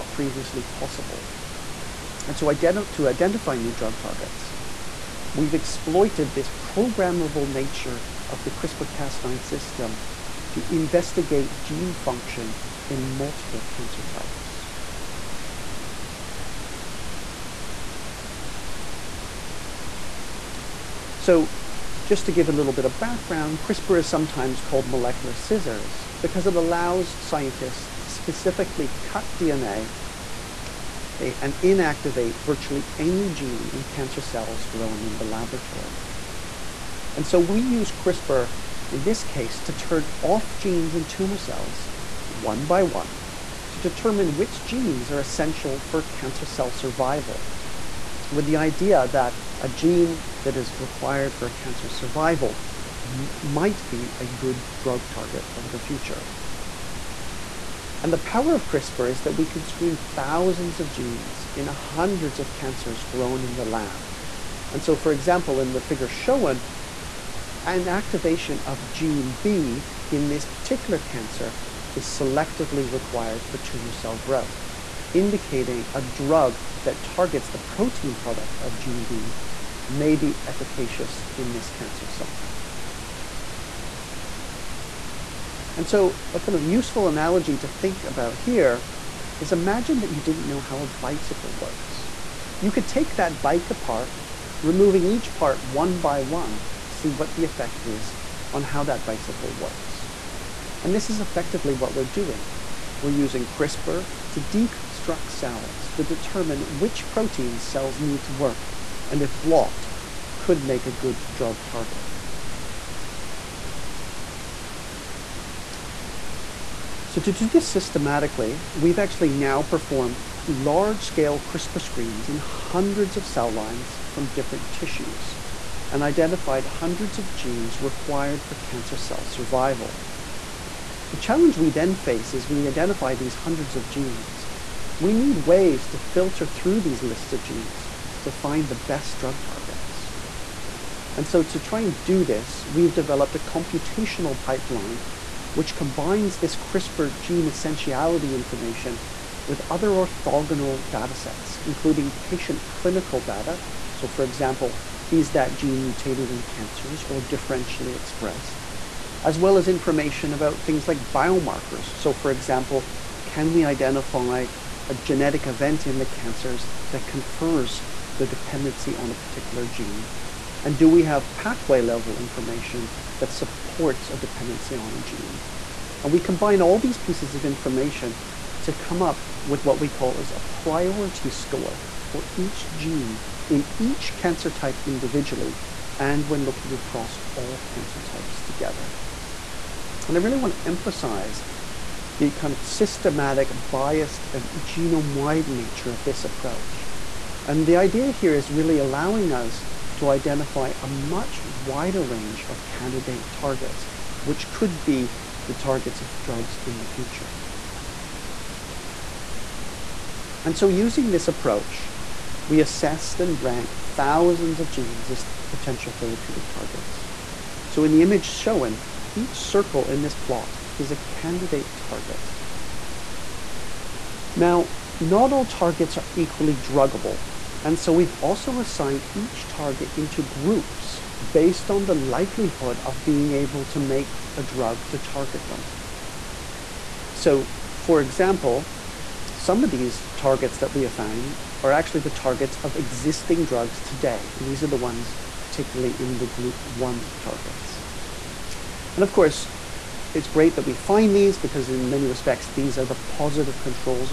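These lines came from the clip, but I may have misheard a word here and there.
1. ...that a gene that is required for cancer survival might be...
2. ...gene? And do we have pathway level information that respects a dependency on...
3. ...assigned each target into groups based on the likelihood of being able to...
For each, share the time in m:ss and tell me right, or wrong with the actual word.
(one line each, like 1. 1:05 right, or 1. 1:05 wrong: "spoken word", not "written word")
1. 0:49 right
2. 2:49 wrong: "supports", not "respects"
3. 3:48 right.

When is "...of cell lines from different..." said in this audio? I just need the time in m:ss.
2:03.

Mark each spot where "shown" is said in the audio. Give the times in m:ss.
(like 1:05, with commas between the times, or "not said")
1:06, 3:38.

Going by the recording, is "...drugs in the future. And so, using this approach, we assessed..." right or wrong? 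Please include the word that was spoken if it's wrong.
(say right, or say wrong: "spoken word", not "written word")
right.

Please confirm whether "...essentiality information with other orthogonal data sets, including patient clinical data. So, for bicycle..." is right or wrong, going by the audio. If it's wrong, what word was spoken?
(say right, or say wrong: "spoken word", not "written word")
wrong: "example", not "bicycle".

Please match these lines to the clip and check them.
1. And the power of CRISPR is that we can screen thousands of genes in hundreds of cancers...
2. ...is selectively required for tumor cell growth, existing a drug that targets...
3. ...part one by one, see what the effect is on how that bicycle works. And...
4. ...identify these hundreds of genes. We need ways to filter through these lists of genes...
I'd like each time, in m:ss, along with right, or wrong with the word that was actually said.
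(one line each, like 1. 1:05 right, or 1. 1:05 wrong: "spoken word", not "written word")
1. 0:58 right
2. 1:11 wrong: "indicating", not "existing"
3. 1:35 right
4. 2:12 right.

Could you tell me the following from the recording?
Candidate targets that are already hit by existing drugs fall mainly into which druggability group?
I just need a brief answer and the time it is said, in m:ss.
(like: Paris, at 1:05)
Group one, at 4:06.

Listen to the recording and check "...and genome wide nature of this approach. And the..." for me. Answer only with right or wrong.
right.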